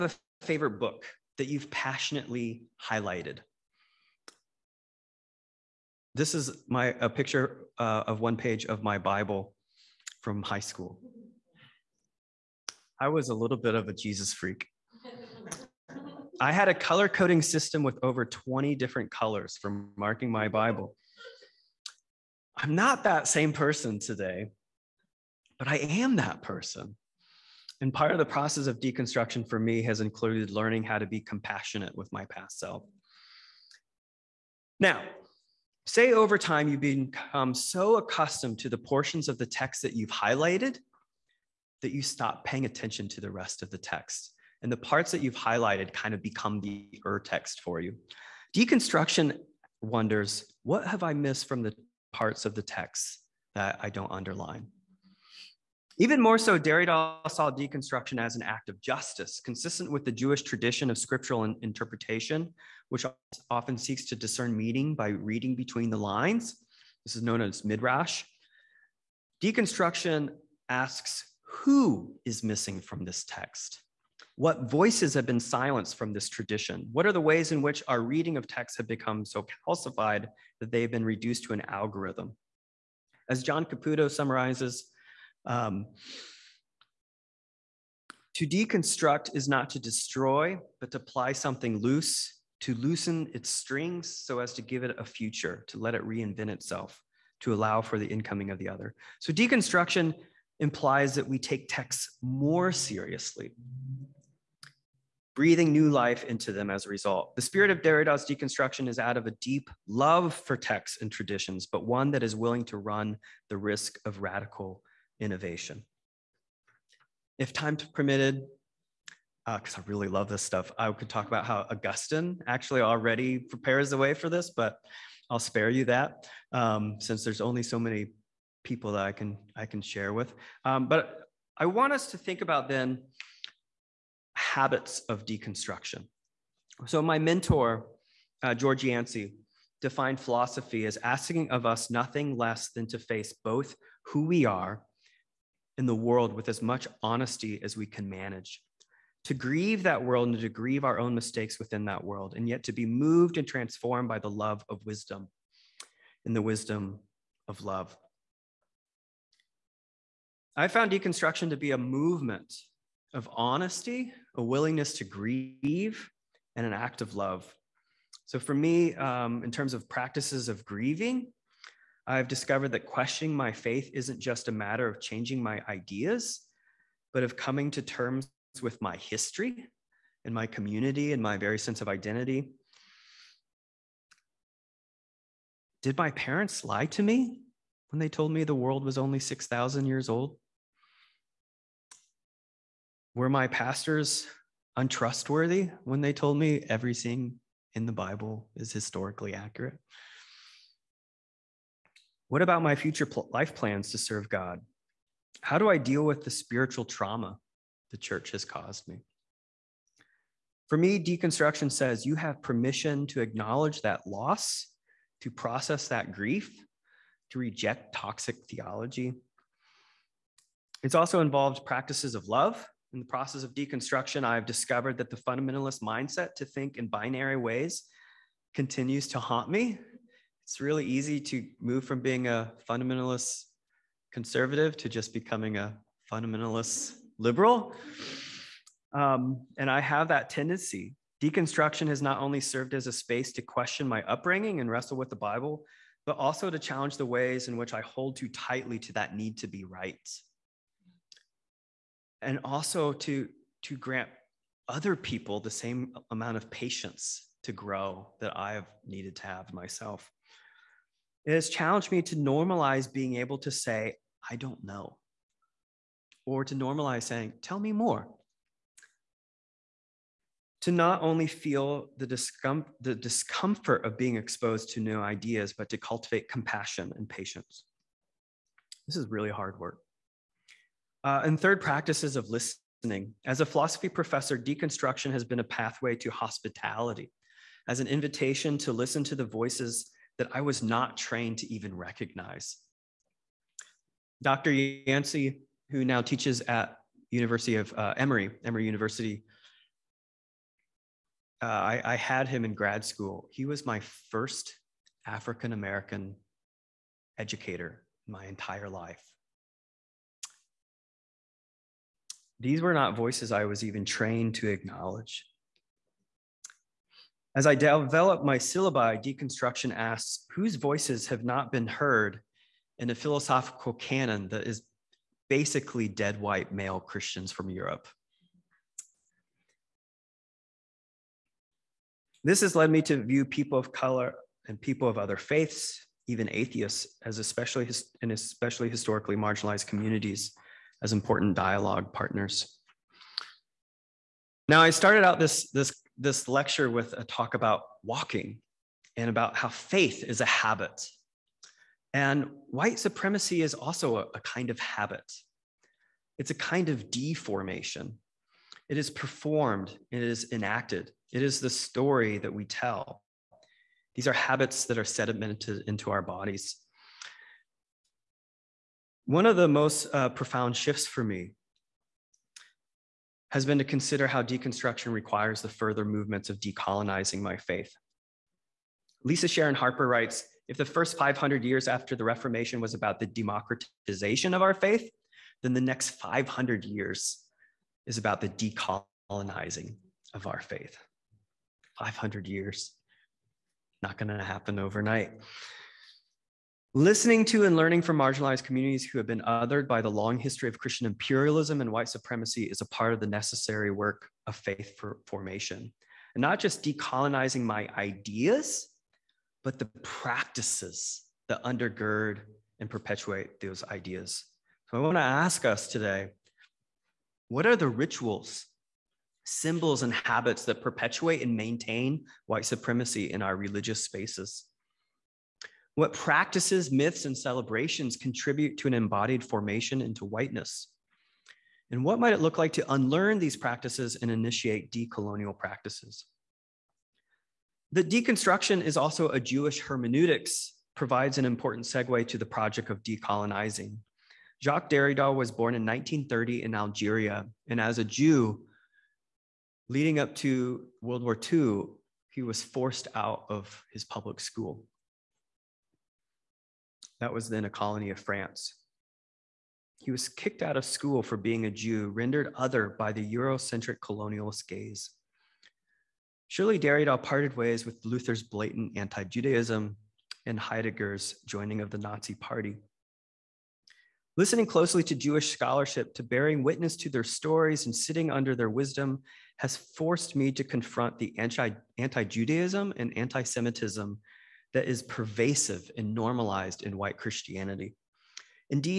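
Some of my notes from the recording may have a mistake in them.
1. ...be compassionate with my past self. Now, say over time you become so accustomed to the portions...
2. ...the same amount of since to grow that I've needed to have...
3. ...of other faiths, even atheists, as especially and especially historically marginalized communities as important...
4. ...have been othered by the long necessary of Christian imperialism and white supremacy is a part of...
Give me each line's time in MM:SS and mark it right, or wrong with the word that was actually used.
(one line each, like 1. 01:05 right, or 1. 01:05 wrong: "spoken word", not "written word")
1. 00:31 right
2. 04:15 wrong: "patience", not "since"
3. 05:34 right
4. 06:38 wrong: "history", not "necessary".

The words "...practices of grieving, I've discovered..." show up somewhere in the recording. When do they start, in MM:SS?
02:49.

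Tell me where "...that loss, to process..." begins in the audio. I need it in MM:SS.
03:33.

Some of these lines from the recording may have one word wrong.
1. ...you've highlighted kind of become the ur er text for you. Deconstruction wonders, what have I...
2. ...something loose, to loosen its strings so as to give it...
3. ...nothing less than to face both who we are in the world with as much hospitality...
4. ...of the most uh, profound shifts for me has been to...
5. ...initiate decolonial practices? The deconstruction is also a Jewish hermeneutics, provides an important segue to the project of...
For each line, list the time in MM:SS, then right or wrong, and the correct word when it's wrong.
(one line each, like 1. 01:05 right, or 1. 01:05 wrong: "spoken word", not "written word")
1. 00:45 right
2. 01:31 right
3. 02:21 wrong: "honesty", not "hospitality"
4. 06:09 right
5. 07:14 right.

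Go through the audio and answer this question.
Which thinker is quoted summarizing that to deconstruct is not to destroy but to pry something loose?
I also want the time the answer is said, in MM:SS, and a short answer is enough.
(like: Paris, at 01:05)
John Caputo, at 01:23.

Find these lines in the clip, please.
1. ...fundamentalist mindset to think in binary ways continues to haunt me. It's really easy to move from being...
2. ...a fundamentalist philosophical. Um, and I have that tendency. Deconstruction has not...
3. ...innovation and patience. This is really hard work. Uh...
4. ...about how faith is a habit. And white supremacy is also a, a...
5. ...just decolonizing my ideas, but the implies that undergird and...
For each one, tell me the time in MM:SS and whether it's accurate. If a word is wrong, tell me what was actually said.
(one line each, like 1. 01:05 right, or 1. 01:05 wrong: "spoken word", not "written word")
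1. 03:45 right
2. 03:55 wrong: "liberal", not "philosophical"
3. 04:36 wrong: "compassion", not "innovation"
4. 05:49 right
5. 06:46 wrong: "practices", not "implies".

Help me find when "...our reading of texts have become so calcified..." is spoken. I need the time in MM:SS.
01:17.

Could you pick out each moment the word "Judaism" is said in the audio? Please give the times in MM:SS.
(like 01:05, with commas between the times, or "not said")
07:49, 08:02.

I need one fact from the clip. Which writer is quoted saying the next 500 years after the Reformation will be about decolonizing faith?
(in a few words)
Lisa Sharon Harper.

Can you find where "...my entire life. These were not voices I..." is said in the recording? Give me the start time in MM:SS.
05:08.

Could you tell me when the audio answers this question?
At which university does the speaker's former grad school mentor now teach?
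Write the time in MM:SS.
04:58.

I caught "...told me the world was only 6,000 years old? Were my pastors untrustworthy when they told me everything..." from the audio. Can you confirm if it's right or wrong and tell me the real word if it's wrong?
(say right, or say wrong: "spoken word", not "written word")
right.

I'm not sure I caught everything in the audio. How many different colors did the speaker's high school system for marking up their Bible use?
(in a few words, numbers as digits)
over 20.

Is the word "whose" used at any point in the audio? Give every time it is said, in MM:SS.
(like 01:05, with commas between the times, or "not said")
05:20.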